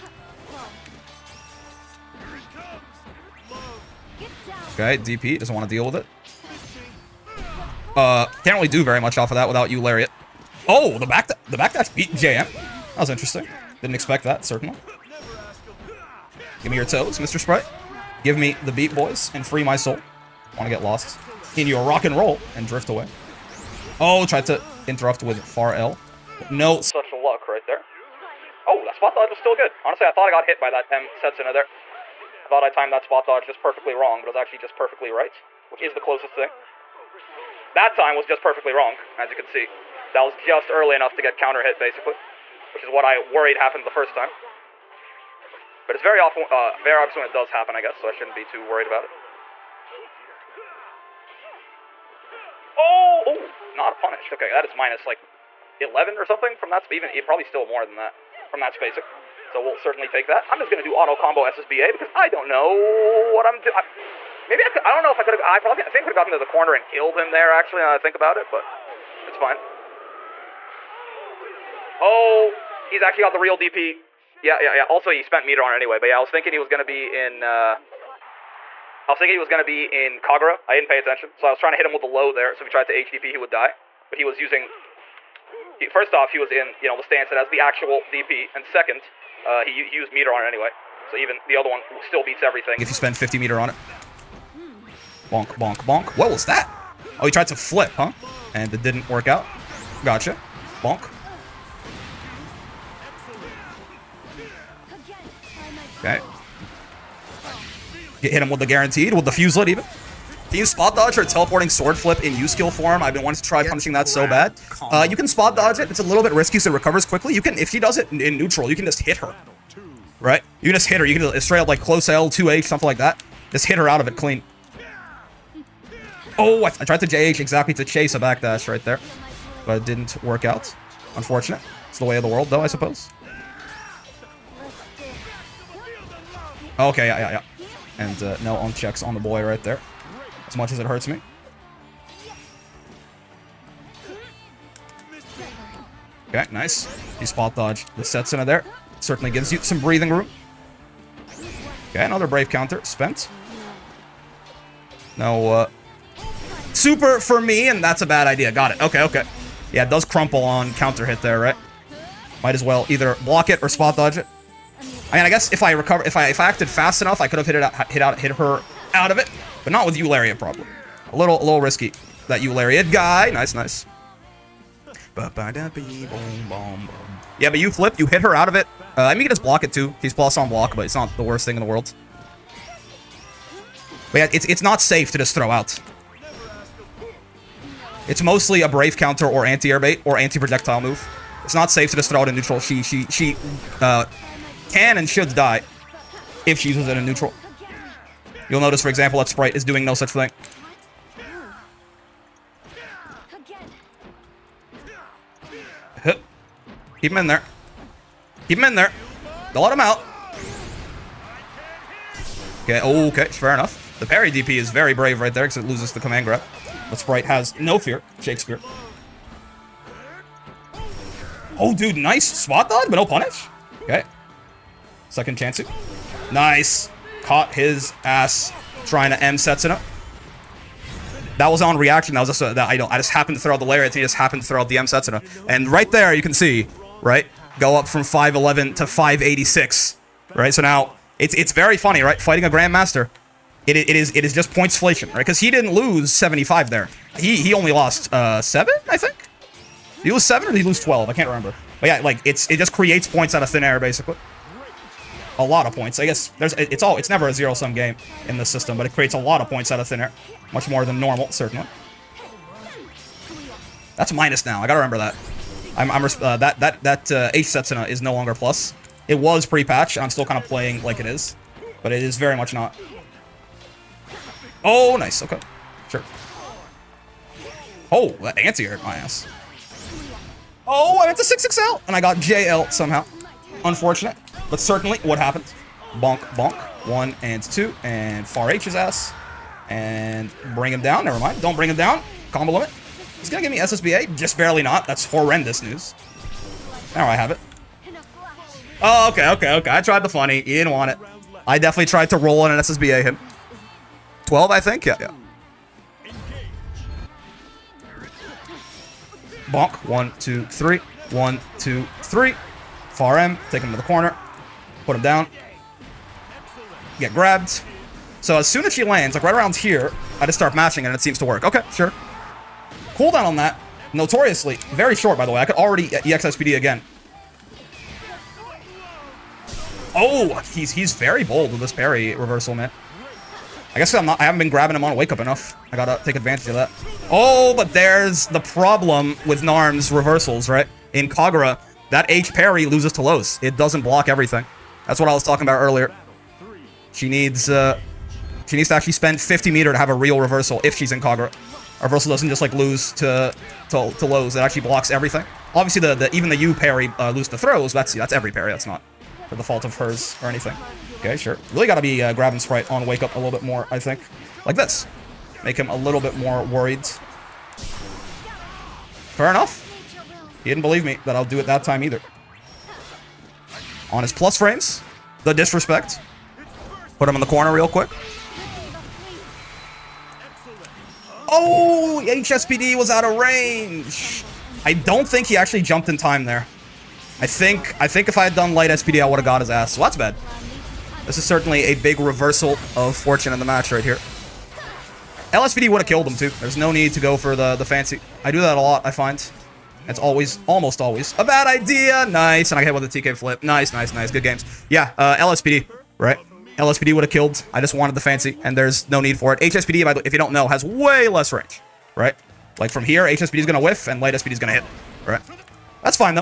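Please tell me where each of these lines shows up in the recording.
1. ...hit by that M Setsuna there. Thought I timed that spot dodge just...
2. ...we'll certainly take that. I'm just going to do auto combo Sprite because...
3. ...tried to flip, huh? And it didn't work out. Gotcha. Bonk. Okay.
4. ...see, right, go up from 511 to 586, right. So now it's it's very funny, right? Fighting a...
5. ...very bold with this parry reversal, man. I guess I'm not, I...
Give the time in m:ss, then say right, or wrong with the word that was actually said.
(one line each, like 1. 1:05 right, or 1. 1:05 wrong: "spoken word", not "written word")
1. 0:30 right
2. 0:59 wrong: "SSBA", not "Sprite"
3. 1:37 right
4. 3:56 right
5. 5:30 right.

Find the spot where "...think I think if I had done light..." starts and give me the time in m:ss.
6:27.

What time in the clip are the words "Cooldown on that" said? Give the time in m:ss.
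5:22.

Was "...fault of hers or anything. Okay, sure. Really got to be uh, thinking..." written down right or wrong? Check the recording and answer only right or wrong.
wrong.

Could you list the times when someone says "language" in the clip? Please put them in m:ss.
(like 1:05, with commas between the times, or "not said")
not said.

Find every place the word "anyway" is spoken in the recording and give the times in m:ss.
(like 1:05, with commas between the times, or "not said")
1:15, 1:30.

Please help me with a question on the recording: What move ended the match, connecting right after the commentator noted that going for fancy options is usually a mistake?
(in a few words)
TK flip.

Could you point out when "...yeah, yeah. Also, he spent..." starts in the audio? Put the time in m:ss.
1:14.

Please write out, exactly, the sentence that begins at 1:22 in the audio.
So if he tried to HDP, he would die.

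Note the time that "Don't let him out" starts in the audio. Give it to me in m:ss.
3:29.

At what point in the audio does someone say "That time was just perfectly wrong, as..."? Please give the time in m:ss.
0:37.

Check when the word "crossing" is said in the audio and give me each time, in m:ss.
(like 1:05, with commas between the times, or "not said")
not said.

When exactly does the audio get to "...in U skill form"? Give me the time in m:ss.
1:52.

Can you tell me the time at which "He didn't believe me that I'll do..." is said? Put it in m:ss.
6:10.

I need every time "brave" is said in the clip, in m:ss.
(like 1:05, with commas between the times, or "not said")
2:32, 3:08, 3:34.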